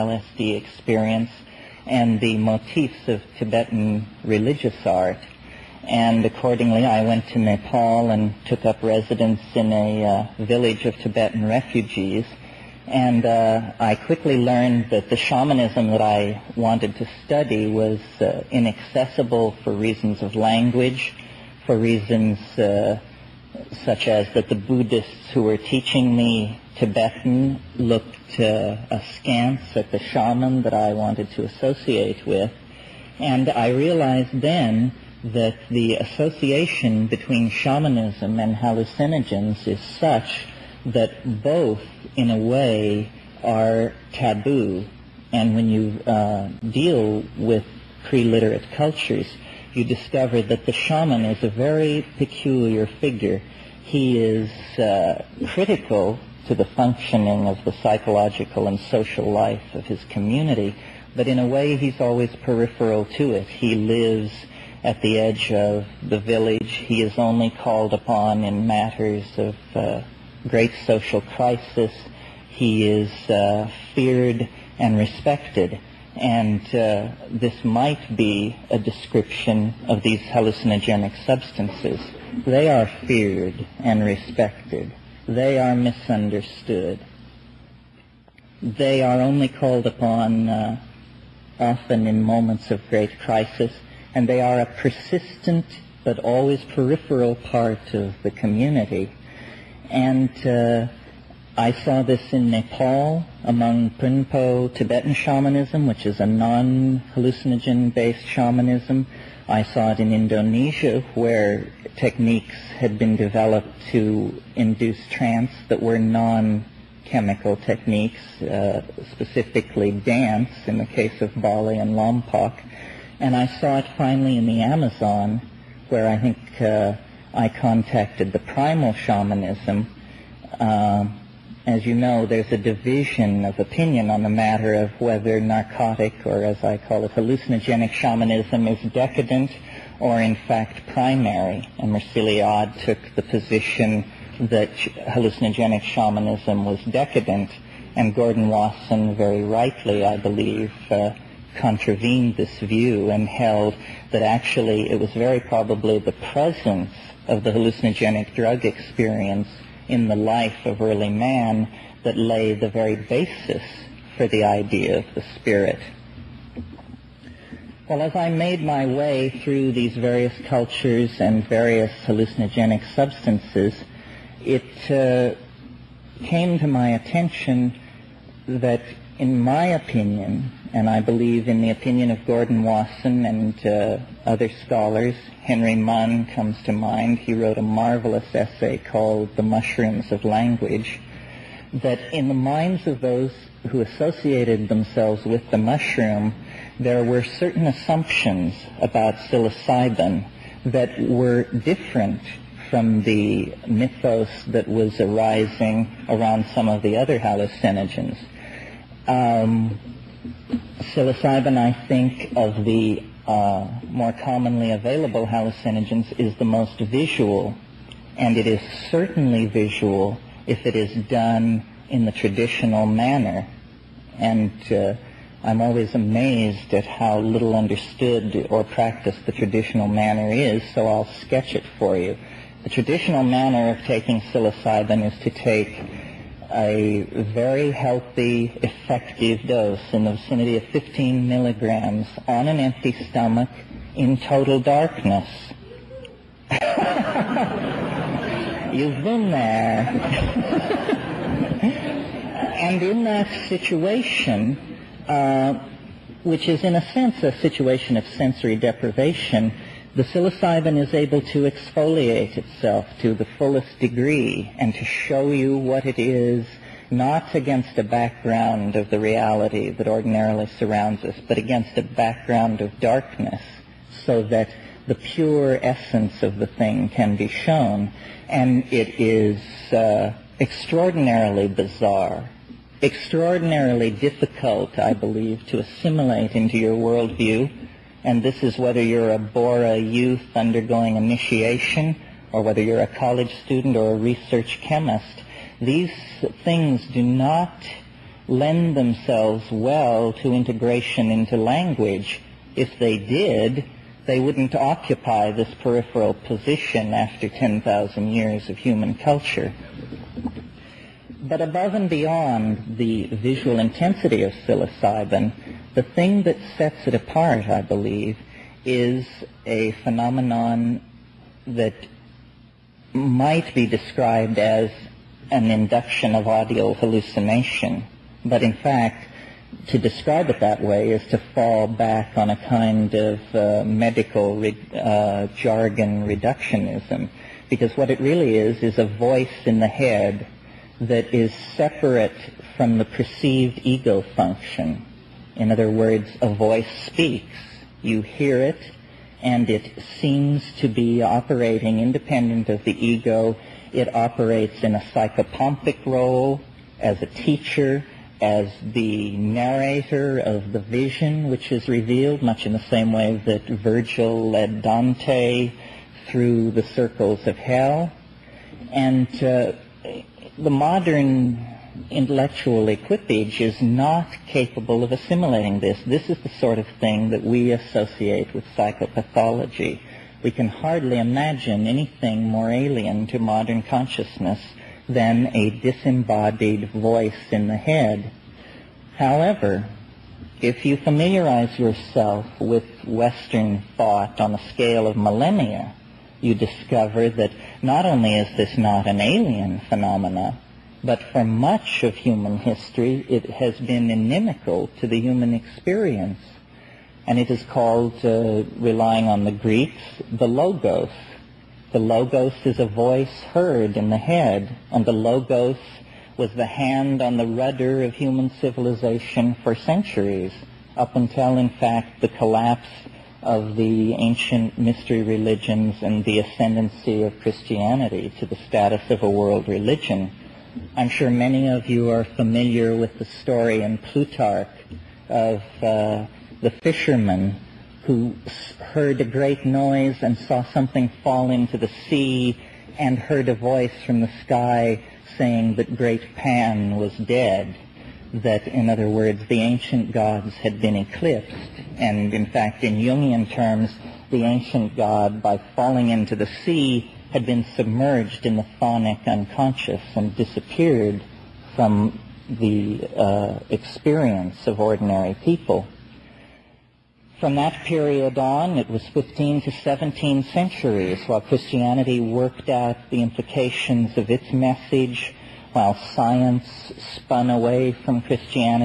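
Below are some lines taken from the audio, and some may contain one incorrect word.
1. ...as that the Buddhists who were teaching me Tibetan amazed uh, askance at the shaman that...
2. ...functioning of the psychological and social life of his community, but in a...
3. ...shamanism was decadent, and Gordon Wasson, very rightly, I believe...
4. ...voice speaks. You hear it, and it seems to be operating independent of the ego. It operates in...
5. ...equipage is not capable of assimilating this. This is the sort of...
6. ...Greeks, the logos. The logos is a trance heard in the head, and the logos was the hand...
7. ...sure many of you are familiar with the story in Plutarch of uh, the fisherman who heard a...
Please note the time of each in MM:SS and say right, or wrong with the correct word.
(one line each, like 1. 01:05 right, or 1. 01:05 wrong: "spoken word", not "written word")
1. 00:24 wrong: "looked", not "amazed"
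2. 00:56 right
3. 02:25 right
4. 05:46 right
5. 06:12 right
6. 06:49 wrong: "voice", not "trance"
7. 07:10 right.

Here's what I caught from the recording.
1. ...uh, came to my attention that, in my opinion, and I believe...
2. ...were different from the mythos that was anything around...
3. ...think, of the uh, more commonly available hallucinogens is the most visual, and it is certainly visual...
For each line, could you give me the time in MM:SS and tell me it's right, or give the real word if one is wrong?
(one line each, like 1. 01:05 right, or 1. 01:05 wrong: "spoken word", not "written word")
1. 02:54 right
2. 03:21 wrong: "arising", not "anything"
3. 03:31 right.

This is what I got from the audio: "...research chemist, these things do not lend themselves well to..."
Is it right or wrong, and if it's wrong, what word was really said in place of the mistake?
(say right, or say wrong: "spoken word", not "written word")
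right.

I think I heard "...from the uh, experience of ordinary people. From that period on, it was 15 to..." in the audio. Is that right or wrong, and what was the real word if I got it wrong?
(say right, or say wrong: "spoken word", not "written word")
right.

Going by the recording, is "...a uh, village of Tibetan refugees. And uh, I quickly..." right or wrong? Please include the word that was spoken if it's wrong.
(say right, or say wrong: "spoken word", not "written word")
right.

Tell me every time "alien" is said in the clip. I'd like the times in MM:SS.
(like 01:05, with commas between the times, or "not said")
06:22, 06:38.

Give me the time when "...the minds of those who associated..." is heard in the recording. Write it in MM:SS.
03:12.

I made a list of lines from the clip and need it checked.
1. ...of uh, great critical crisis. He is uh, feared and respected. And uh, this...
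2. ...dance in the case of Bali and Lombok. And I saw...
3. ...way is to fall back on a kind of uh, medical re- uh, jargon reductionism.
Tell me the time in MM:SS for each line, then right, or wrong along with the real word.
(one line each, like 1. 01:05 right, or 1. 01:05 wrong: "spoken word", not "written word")
1. 01:09 wrong: "social", not "critical"
2. 01:59 right
3. 05:30 right.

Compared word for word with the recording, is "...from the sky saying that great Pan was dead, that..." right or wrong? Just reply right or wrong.
right.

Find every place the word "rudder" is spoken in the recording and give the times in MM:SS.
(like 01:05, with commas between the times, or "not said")
06:57.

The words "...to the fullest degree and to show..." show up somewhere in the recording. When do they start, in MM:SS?
04:22.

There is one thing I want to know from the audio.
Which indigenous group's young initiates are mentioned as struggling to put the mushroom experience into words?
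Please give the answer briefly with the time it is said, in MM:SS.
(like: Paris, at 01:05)
Bora, at 04:49.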